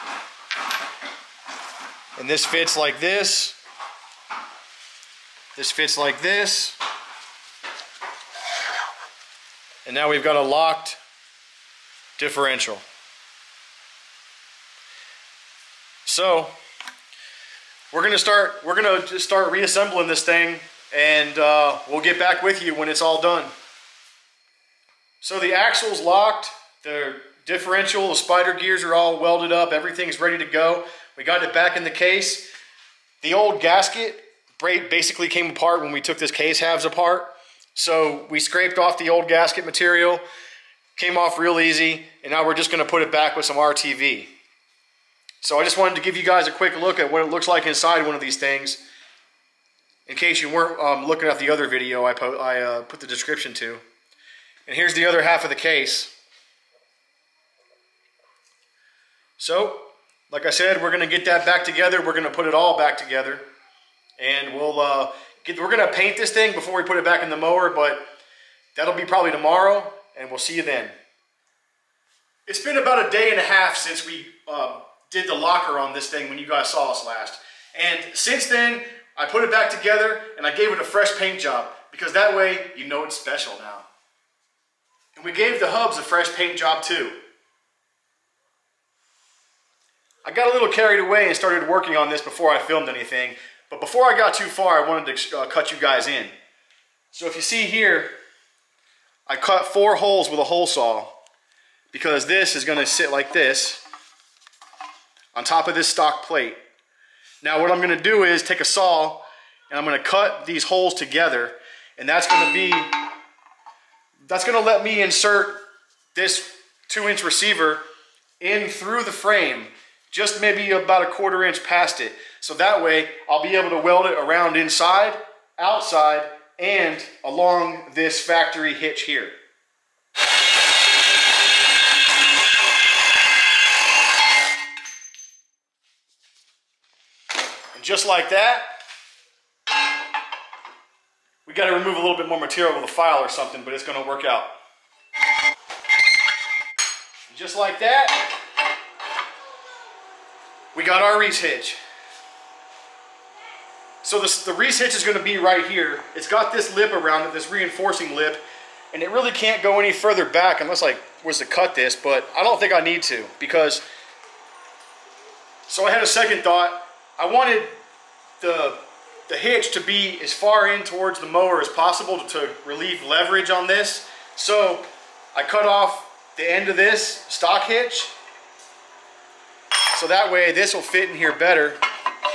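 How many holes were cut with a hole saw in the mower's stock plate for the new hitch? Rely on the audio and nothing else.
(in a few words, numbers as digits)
4.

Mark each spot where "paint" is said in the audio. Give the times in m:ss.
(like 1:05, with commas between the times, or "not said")
1:05, 1:21, 1:26.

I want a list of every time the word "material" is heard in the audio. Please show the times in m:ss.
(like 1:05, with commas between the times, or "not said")
0:39, 2:22.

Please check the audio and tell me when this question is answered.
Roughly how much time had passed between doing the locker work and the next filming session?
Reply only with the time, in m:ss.
1:12.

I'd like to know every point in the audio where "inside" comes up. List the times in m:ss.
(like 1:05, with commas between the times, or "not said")
0:47, 2:04.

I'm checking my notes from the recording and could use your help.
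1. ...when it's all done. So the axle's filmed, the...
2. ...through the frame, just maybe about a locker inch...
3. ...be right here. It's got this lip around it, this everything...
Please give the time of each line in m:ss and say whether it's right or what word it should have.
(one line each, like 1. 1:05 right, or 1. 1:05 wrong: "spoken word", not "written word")
1. 0:22 wrong: "locked", not "filmed"
2. 1:58 wrong: "quarter", not "locker"
3. 2:35 wrong: "reinforcing", not "everything".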